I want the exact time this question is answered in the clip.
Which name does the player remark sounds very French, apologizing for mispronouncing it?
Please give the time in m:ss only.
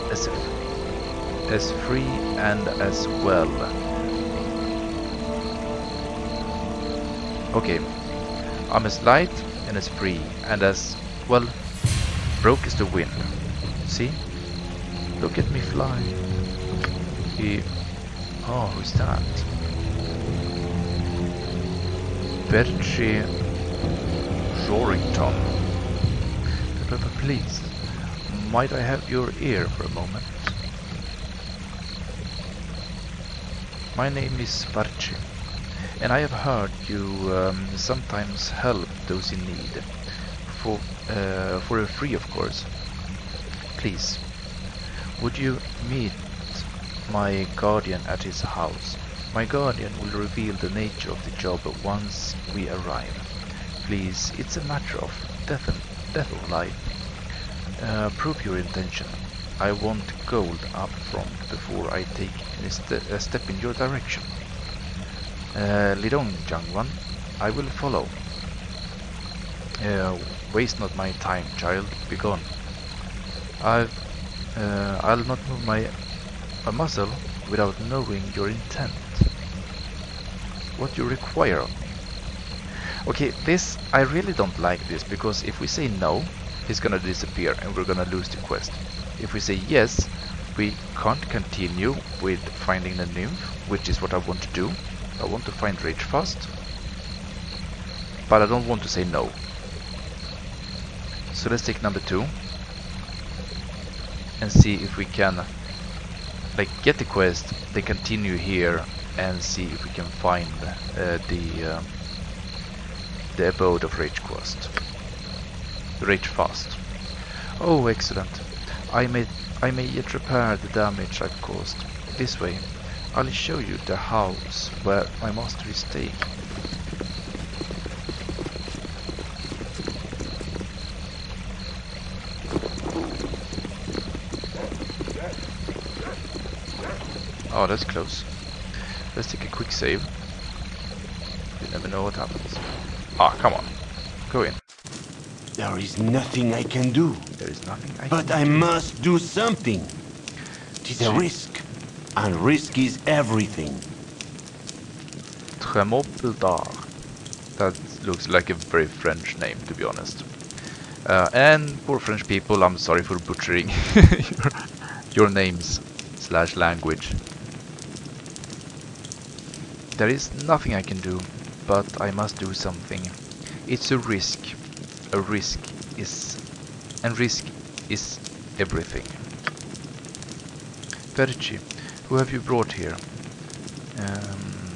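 2:35.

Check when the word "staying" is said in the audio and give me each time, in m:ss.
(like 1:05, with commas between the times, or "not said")
2:05.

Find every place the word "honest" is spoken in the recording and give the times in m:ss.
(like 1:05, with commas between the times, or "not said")
2:39.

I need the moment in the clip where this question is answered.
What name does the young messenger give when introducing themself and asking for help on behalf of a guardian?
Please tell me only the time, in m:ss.
0:34.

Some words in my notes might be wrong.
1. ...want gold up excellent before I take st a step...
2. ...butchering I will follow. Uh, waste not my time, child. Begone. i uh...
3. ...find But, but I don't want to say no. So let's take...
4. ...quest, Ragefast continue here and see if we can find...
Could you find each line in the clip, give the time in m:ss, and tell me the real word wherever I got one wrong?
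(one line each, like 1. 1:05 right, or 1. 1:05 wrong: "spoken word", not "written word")
1. 0:59 wrong: "front", not "excellent"
2. 1:06 wrong: "young", not "butchering"
3. 1:35 wrong: "Ragefast", not "But"
4. 1:47 wrong: "They", not "Ragefast".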